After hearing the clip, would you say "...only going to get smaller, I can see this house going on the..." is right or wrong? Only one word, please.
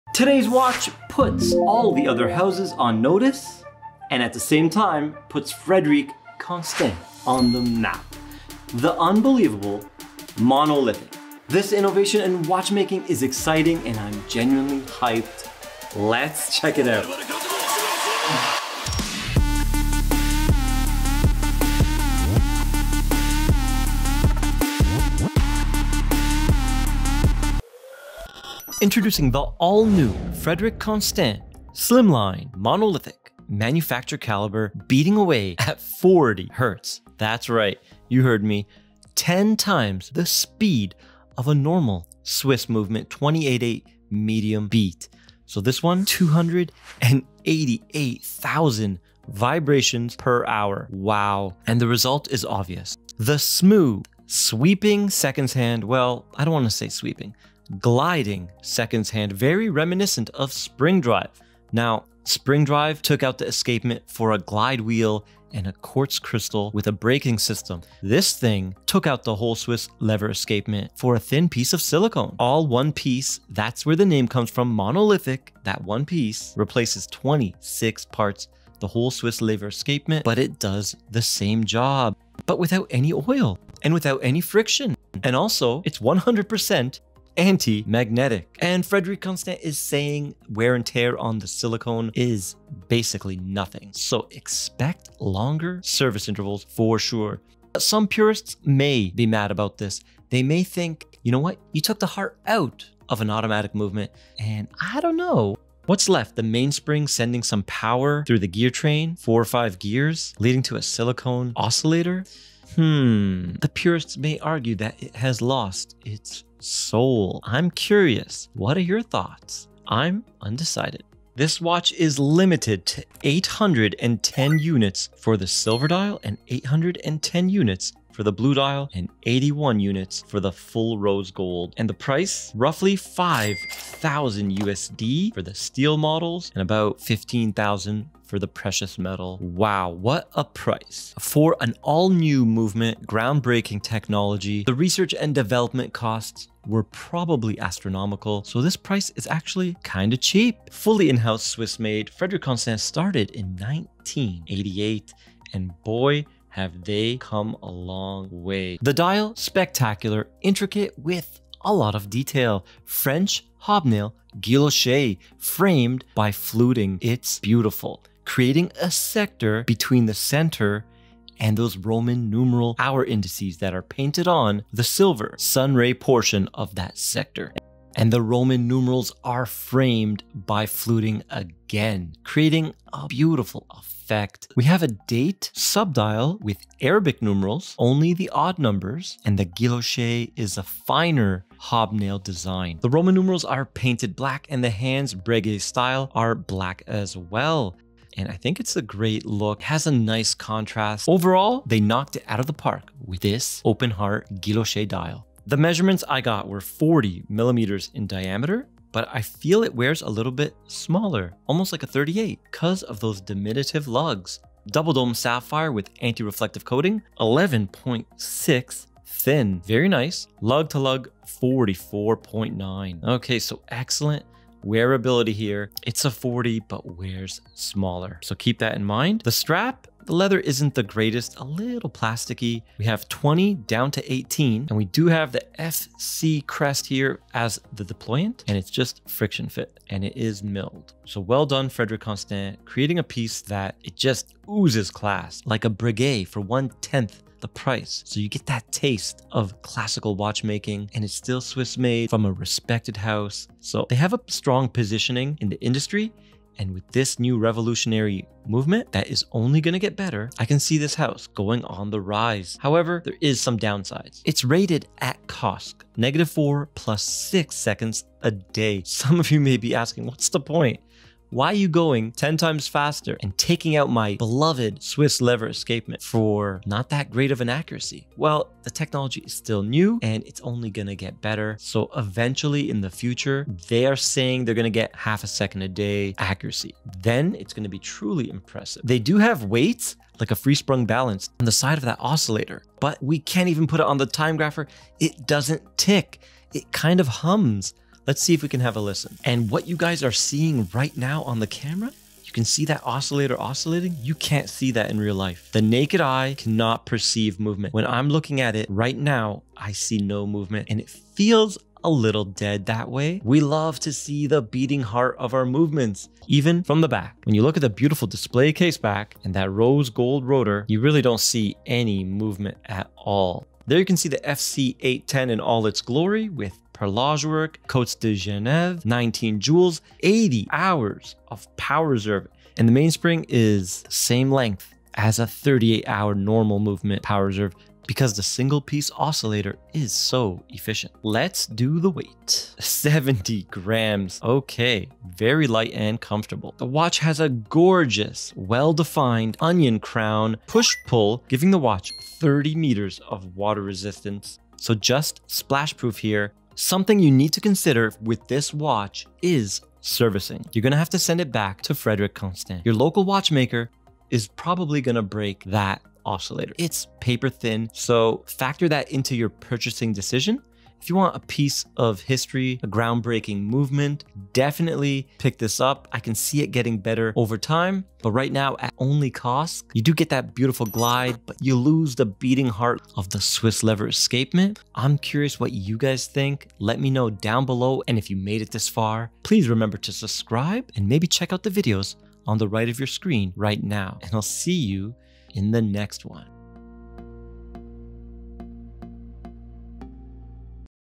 wrong.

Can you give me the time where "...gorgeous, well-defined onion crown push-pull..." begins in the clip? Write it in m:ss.
5:47.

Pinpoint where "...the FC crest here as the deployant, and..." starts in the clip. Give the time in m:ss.
3:55.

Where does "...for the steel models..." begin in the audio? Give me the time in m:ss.
2:15.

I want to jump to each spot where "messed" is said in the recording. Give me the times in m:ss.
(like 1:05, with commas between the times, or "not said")
not said.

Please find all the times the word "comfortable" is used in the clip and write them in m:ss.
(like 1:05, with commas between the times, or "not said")
5:46.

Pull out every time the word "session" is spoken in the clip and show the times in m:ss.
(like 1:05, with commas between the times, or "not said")
not said.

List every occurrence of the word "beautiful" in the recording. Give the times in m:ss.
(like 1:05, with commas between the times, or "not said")
2:47, 3:03, 5:17, 6:20.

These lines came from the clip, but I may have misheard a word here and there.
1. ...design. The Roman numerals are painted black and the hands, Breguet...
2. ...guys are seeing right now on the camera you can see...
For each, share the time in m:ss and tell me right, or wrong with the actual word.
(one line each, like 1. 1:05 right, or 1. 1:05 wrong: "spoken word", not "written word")
1. 3:12 right
2. 4:59 right.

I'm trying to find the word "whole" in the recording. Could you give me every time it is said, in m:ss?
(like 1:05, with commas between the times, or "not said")
1:09, 1:18.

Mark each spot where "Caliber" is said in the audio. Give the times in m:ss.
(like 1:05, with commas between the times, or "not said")
0:34.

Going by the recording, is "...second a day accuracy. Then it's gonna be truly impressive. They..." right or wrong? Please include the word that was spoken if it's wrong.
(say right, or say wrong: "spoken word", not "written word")
right.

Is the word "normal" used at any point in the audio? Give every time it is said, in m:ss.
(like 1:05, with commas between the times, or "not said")
0:41, 5:36.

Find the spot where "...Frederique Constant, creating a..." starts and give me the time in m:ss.
4:01.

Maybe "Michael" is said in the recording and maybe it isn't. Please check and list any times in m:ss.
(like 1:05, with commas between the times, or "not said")
not said.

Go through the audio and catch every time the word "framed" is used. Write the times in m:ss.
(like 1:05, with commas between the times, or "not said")
2:45, 2:59.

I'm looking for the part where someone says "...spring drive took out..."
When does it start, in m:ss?
1:02.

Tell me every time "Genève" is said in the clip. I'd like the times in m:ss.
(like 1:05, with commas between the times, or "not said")
5:28.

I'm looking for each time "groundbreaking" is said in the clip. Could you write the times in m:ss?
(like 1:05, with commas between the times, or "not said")
2:23, 6:12.